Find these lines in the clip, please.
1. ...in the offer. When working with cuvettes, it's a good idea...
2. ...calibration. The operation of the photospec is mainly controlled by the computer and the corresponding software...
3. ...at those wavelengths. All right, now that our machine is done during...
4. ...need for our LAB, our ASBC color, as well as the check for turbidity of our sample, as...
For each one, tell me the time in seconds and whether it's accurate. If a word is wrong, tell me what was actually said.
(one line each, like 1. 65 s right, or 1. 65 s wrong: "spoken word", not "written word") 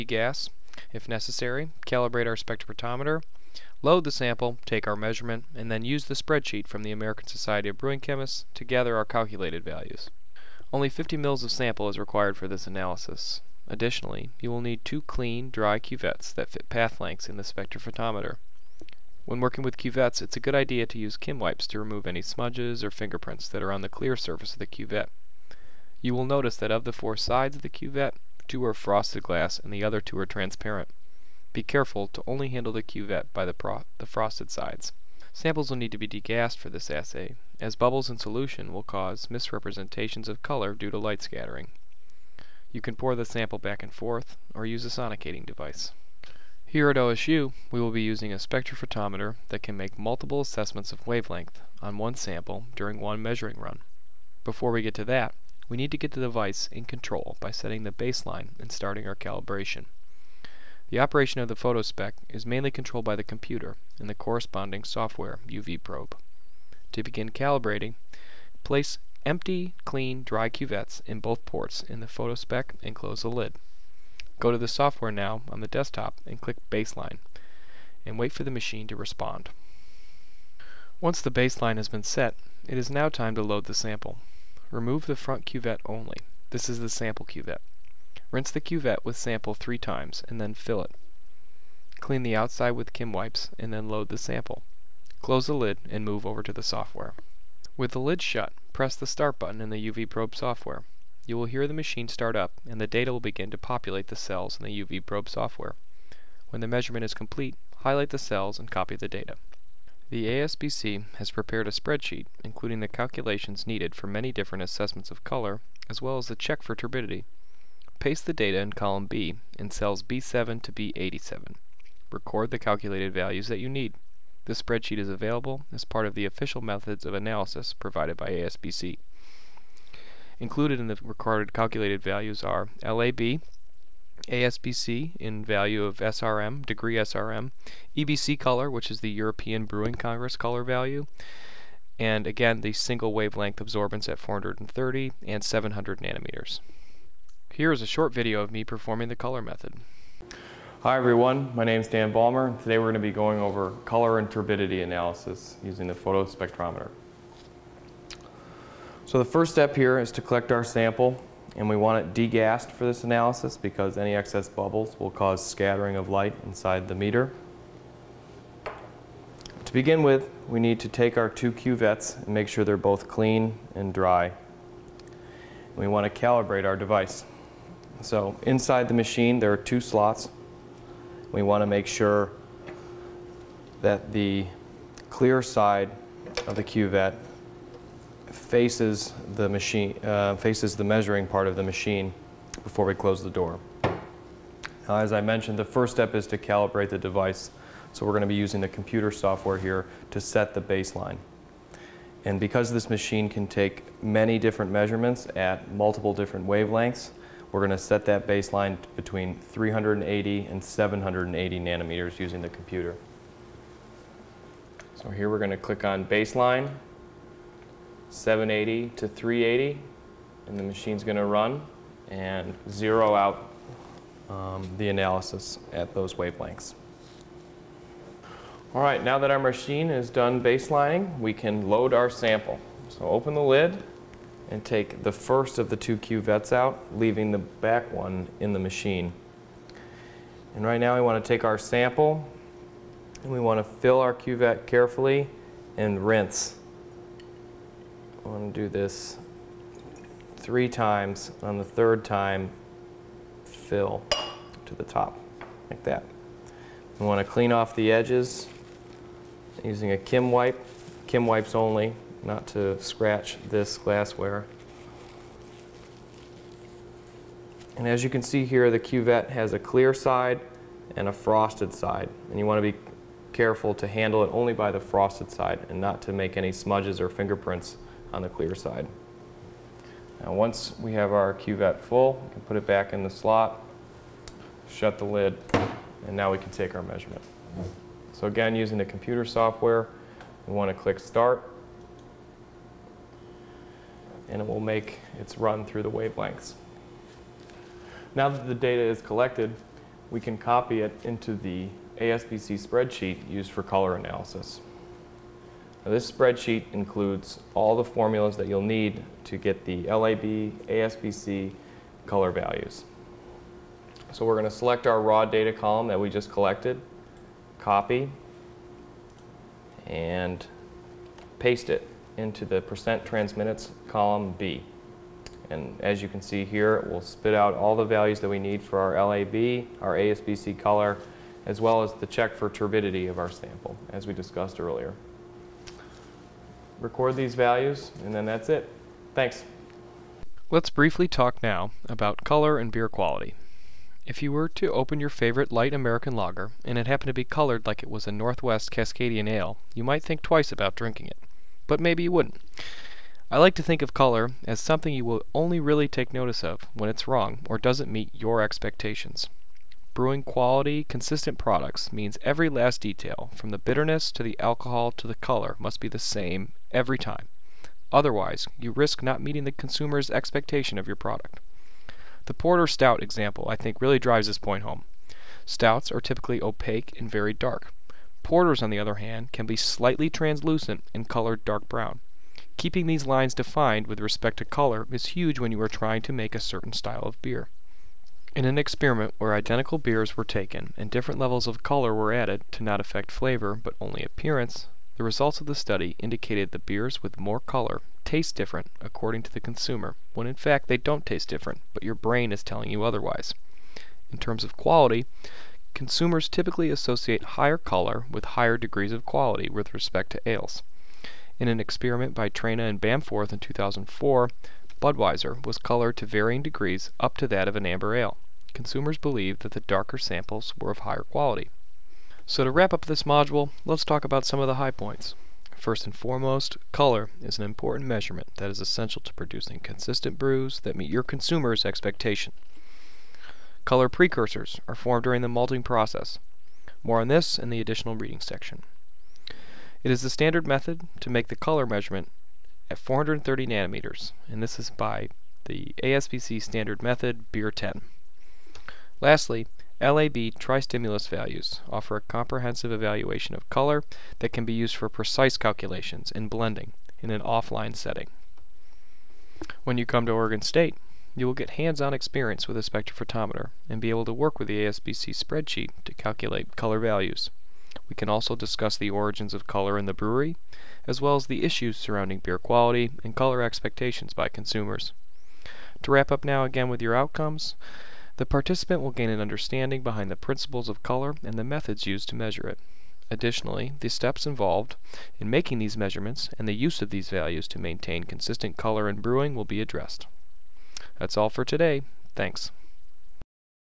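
1. 17 s wrong: "spectrophotometer", not "offer"
2. 59 s right
3. 225 s wrong: "baselining", not "during"
4. 328 s right.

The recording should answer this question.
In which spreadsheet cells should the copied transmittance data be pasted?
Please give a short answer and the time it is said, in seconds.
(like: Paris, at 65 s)
B7 to B87, at 120 s.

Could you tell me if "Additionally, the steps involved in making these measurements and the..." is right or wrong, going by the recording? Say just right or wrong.
right.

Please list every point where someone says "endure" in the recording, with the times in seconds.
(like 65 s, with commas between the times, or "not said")
not said.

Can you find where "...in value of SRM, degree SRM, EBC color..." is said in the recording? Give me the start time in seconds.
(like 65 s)
135 s.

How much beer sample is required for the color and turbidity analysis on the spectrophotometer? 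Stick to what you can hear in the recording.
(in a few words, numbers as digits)
50 mils.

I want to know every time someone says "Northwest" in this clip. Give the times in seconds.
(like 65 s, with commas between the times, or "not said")
348 s.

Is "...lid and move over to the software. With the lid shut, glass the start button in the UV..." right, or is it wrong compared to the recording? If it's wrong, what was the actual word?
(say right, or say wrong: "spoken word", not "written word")
wrong: "press", not "glass".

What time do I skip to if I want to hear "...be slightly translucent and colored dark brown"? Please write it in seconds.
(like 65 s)
379 s.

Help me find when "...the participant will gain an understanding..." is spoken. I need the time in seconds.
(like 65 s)
478 s.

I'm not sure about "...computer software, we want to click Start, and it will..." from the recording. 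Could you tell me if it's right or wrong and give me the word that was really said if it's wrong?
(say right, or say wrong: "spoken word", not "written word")
right.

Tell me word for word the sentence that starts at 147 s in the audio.
Here is a short video of me performing the color method.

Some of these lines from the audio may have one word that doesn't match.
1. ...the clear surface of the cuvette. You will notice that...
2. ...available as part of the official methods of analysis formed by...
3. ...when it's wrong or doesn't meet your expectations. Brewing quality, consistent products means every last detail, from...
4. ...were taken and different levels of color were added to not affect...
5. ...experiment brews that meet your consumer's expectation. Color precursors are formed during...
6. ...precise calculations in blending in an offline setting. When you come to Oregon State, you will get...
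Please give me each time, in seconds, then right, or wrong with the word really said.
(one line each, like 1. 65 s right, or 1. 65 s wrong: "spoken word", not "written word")
1. 23 s right
2. 125 s wrong: "provided", not "formed"
3. 356 s right
4. 390 s right
5. 429 s wrong: "consistent", not "experiment"
6. 454 s right.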